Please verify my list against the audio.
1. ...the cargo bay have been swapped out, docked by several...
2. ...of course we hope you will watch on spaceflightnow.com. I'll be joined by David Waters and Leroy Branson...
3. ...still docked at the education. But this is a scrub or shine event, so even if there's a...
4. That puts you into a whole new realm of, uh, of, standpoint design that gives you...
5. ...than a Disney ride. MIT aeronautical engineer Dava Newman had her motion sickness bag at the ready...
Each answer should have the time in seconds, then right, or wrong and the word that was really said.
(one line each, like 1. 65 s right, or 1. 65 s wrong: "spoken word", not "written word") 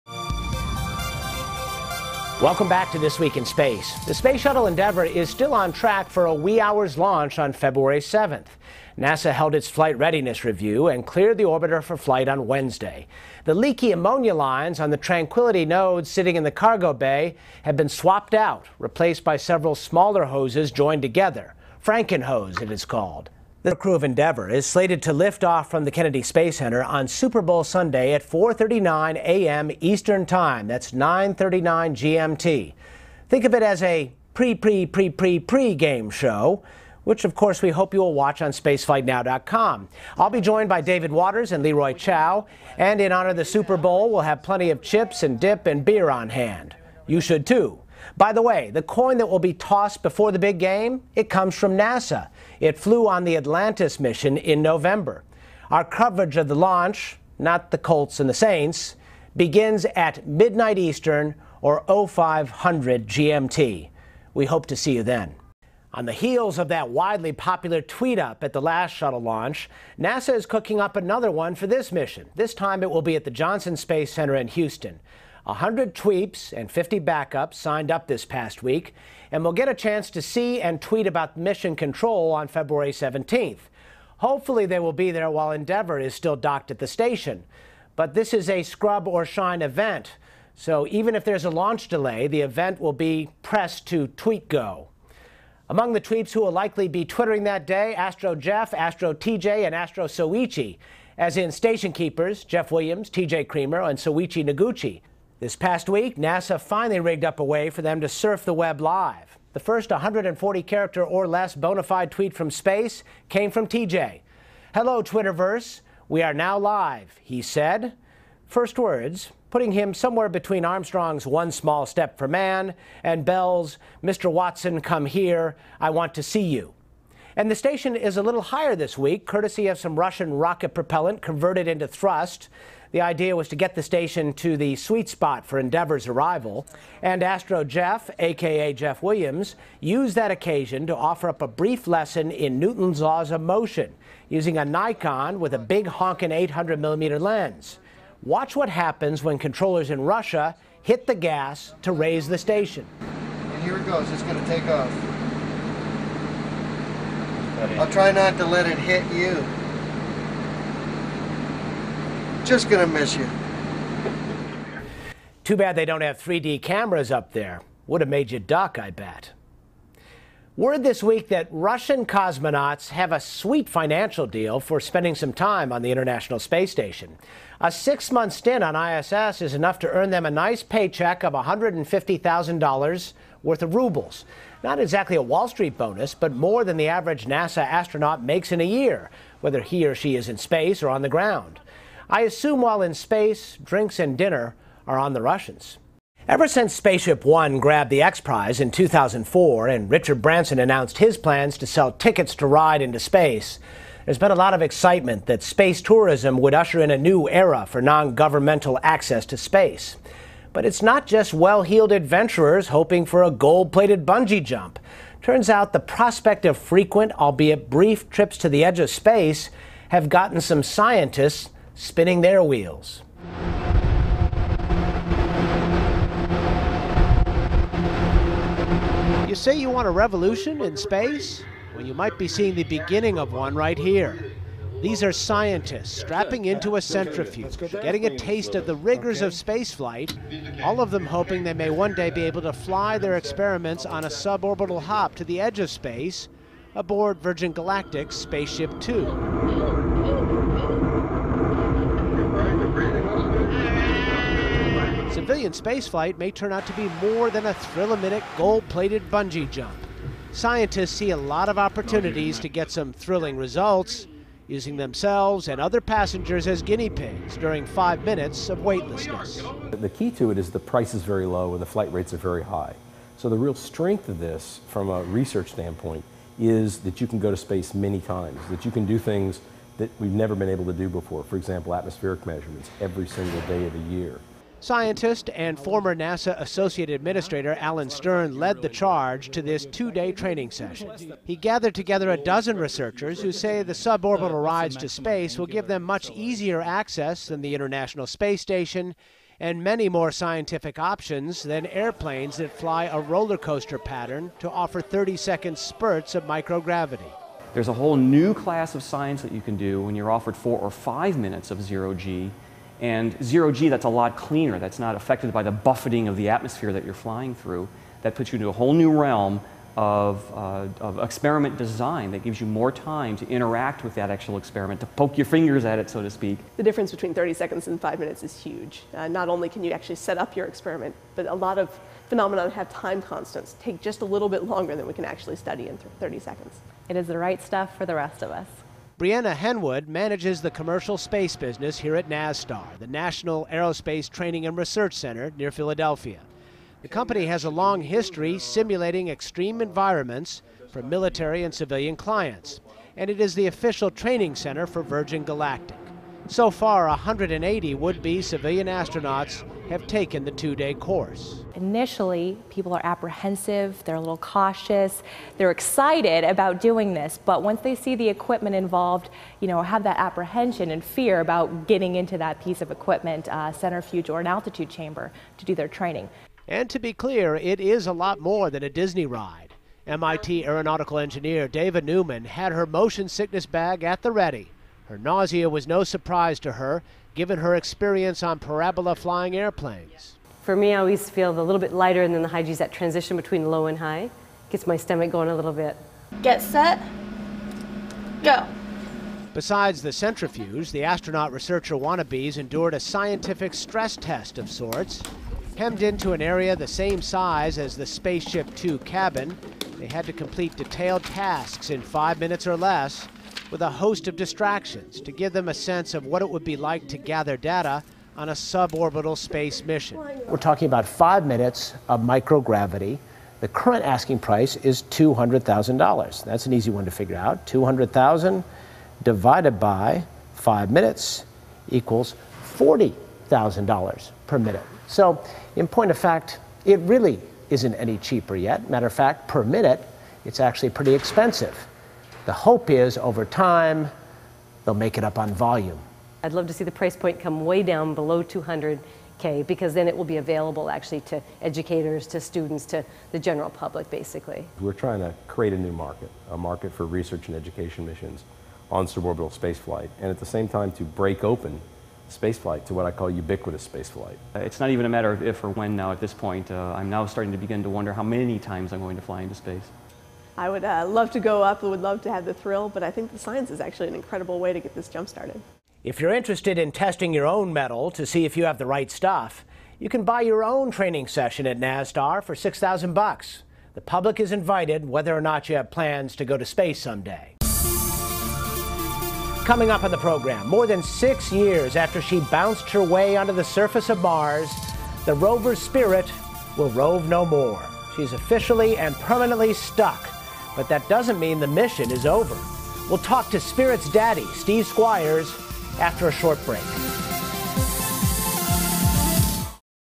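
1. 16 s wrong: "replaced", not "docked"
2. 37 s wrong: "Chiao", not "Branson"
3. 86 s wrong: "station", not "education"
4. 318 s wrong: "experiment", not "standpoint"
5. 378 s right.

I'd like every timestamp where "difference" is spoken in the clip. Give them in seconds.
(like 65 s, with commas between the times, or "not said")
326 s.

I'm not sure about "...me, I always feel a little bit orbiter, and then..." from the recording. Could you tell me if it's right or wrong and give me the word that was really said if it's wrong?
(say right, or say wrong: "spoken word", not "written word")
wrong: "lighter", not "orbiter".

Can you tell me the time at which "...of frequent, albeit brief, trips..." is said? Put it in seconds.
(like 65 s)
216 s.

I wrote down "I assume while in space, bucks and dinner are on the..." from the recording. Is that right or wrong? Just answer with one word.
wrong.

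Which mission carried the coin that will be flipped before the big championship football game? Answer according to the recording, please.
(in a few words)
Atlantis.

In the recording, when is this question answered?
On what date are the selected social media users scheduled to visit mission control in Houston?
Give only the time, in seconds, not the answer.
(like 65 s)
82 s.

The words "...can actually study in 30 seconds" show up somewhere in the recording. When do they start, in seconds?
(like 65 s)
334 s.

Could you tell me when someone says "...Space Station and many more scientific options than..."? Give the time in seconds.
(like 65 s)
298 s.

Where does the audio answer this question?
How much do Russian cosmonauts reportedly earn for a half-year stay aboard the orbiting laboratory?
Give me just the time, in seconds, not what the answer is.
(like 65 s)
181 s.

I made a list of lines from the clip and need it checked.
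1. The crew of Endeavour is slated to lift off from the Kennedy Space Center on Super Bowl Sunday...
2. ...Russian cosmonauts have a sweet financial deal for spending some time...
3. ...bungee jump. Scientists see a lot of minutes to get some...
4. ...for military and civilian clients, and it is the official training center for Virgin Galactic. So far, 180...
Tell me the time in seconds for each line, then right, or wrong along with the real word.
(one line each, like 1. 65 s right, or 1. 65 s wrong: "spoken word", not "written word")
1. 23 s right
2. 171 s right
3. 259 s wrong: "opportunities", not "minutes"
4. 350 s right.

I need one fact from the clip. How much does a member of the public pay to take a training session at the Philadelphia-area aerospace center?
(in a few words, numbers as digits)
$6,000.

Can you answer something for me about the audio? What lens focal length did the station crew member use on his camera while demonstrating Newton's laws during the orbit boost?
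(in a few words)
800 millimeter.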